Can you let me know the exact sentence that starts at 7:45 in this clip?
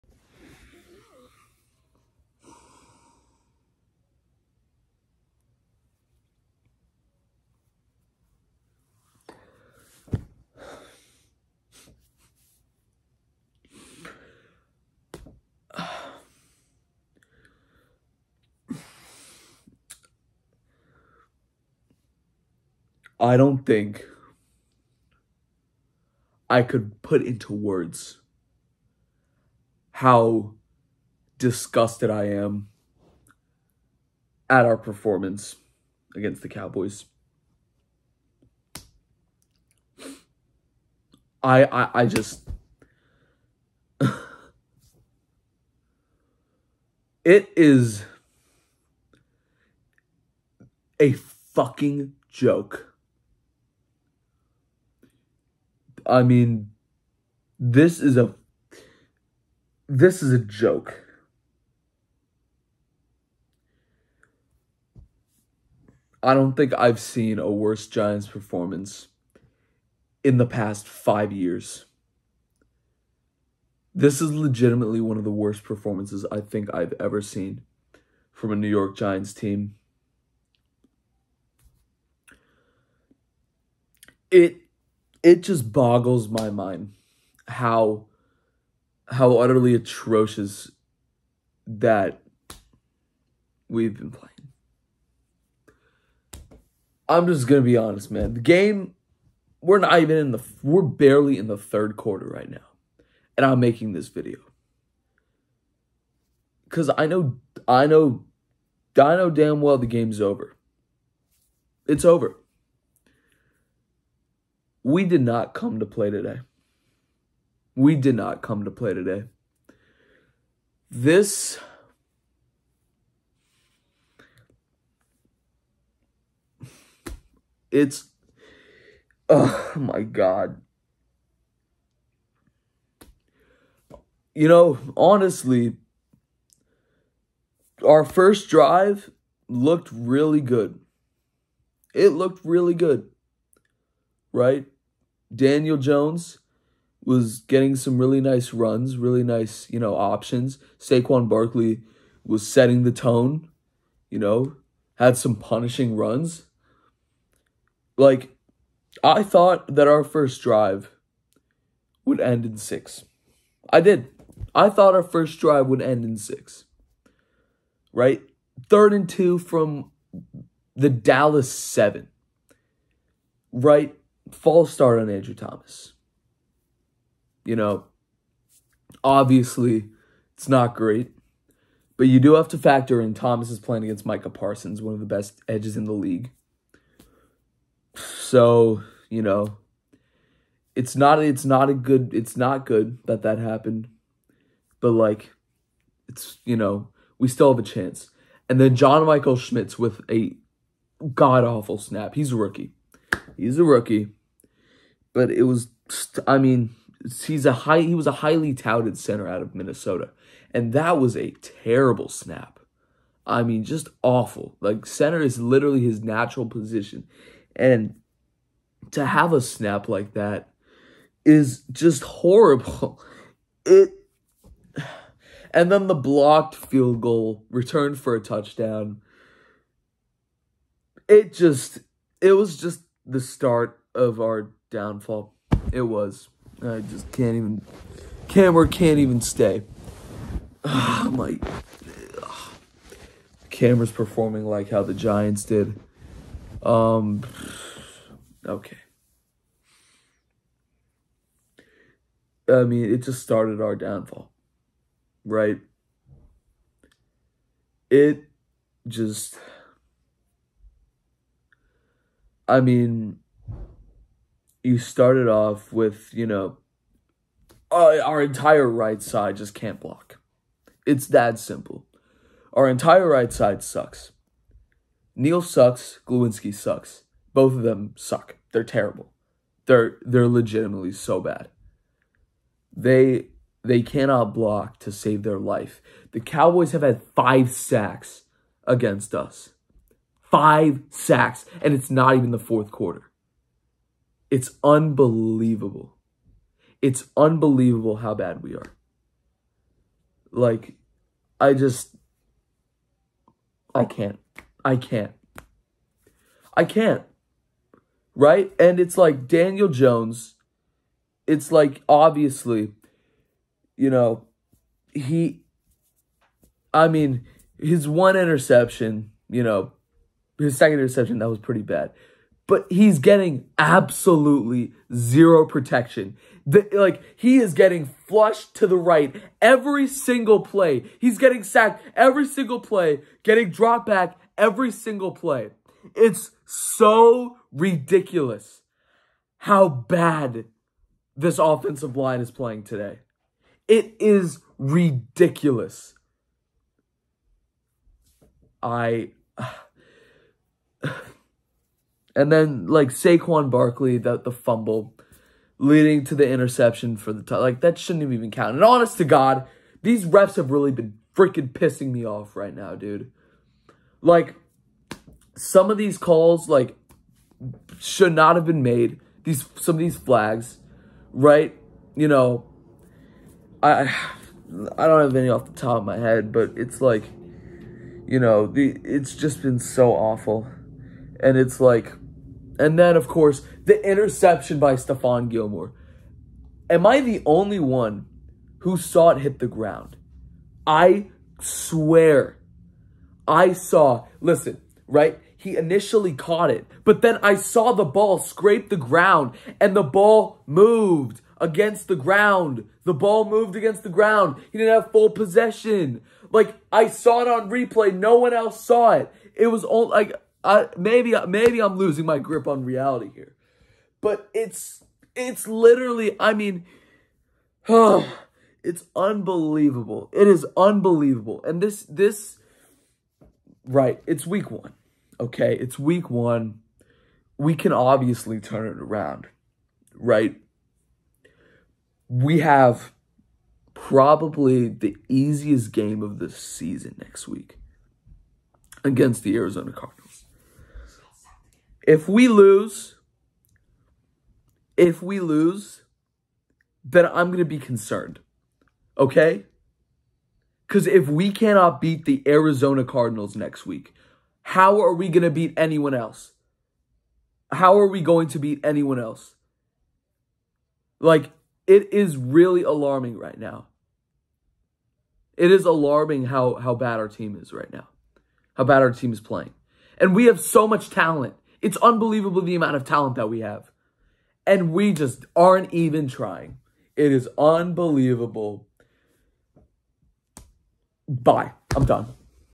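It is alarming how, how bad our team is right now, how bad our team is playing.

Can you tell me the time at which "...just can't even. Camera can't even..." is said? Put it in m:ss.
3:56.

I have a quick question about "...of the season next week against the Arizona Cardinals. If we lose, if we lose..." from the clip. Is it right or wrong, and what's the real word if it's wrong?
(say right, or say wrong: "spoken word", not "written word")
right.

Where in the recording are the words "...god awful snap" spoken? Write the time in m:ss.
3:21.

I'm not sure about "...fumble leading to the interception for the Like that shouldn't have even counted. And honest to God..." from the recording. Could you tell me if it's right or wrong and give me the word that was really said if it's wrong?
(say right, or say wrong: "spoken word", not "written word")
right.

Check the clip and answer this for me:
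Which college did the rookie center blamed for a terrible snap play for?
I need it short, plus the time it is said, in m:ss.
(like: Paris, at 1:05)
Minnesota, at 3:29.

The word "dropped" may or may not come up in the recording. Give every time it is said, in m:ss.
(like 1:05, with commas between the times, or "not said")
5:33.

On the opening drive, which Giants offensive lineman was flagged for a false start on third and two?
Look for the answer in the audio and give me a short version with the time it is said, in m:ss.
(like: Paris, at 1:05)
Andrew Thomas, at 2:55.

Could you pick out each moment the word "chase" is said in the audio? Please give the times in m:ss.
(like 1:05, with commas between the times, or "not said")
not said.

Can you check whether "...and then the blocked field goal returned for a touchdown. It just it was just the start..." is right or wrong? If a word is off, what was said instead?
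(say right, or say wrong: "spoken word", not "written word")
right.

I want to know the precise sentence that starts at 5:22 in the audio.
But he's getting absolutely zero protection.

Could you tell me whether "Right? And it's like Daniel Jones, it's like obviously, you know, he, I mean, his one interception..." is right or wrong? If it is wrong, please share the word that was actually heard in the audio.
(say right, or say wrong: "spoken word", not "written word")
right.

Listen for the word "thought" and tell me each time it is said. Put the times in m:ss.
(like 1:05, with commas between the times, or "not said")
2:39, 2:44.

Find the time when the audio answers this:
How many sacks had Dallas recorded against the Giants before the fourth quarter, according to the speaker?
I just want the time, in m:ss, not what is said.
4:47.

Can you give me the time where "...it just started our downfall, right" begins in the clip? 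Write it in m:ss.
4:12.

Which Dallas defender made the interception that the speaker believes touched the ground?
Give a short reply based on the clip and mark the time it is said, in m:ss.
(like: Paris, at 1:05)
Stephon Gilmore, at 6:24.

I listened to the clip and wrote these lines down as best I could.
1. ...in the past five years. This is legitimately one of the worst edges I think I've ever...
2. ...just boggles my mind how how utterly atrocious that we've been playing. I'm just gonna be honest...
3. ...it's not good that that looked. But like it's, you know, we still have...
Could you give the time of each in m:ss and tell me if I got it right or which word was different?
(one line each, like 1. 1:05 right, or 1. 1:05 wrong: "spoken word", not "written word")
1. 1:10 wrong: "performances", not "edges"
2. 1:25 right
3. 3:12 wrong: "happened", not "looked".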